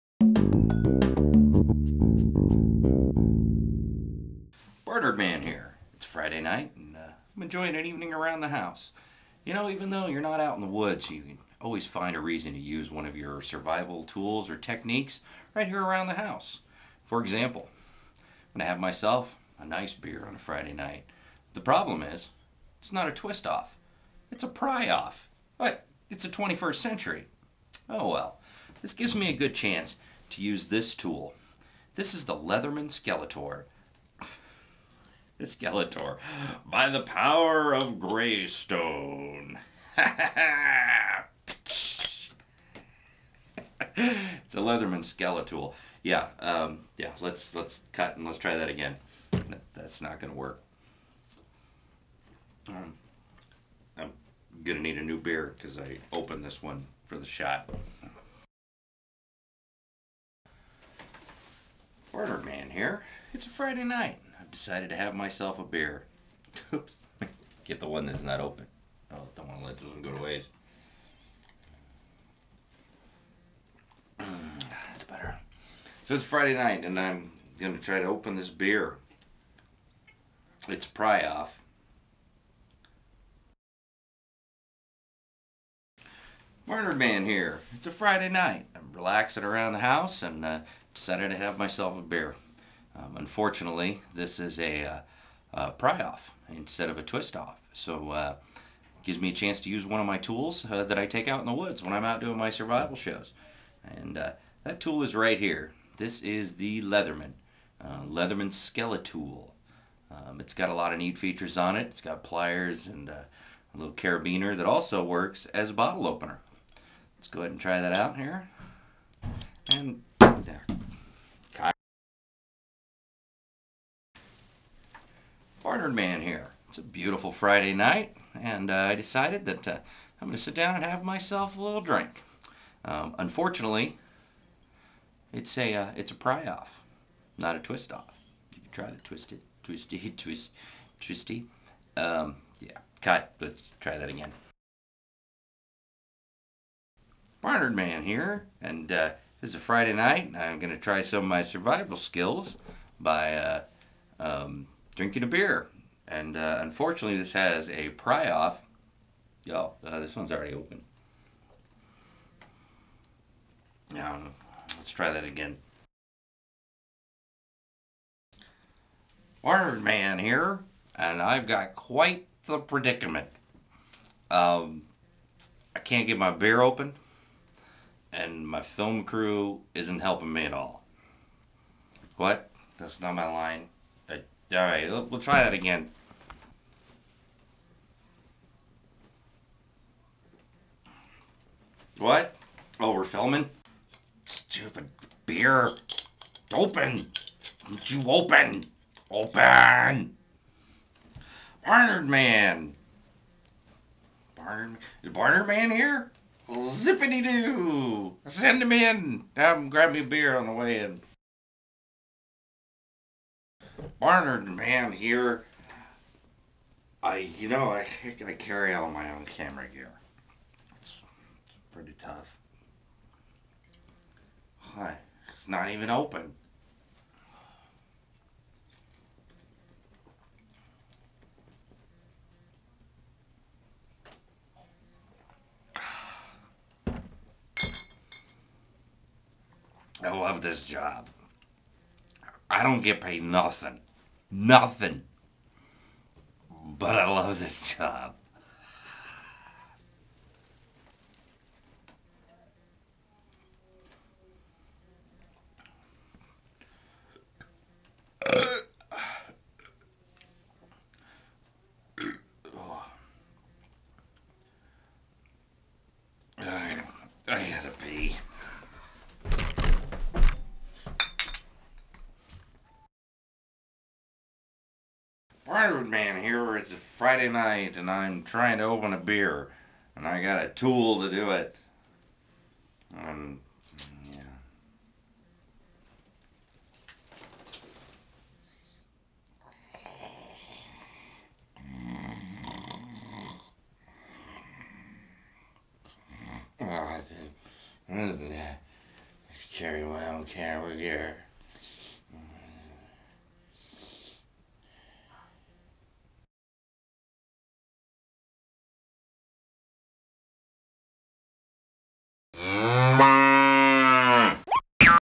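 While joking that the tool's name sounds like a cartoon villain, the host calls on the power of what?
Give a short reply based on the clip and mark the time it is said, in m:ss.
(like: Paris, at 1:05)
Greystone, at 0:37.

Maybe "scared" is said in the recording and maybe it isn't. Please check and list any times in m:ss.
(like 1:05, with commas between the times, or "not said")
not said.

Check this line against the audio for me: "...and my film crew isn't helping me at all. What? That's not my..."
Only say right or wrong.
right.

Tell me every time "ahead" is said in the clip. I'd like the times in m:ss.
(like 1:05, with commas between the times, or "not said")
1:57.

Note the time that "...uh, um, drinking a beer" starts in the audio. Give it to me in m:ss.
2:33.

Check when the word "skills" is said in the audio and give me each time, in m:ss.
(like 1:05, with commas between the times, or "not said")
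2:31.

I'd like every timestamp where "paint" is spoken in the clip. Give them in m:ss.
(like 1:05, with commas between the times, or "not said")
not said.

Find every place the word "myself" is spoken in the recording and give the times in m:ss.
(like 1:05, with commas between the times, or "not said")
0:18, 1:05, 1:31, 2:11.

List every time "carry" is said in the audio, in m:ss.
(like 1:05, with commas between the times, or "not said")
3:38, 4:59.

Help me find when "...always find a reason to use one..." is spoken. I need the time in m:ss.
0:11.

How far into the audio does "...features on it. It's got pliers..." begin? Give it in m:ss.
1:51.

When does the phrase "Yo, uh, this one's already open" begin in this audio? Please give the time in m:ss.
2:39.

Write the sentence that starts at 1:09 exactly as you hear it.
Oh, don't want to let this one go to waste.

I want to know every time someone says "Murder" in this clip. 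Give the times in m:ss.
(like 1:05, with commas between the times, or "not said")
1:26.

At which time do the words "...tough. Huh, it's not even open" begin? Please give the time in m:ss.
3:41.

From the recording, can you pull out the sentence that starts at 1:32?
Um, unfortunately, this is a, uh, a, pry off instead of a twist off.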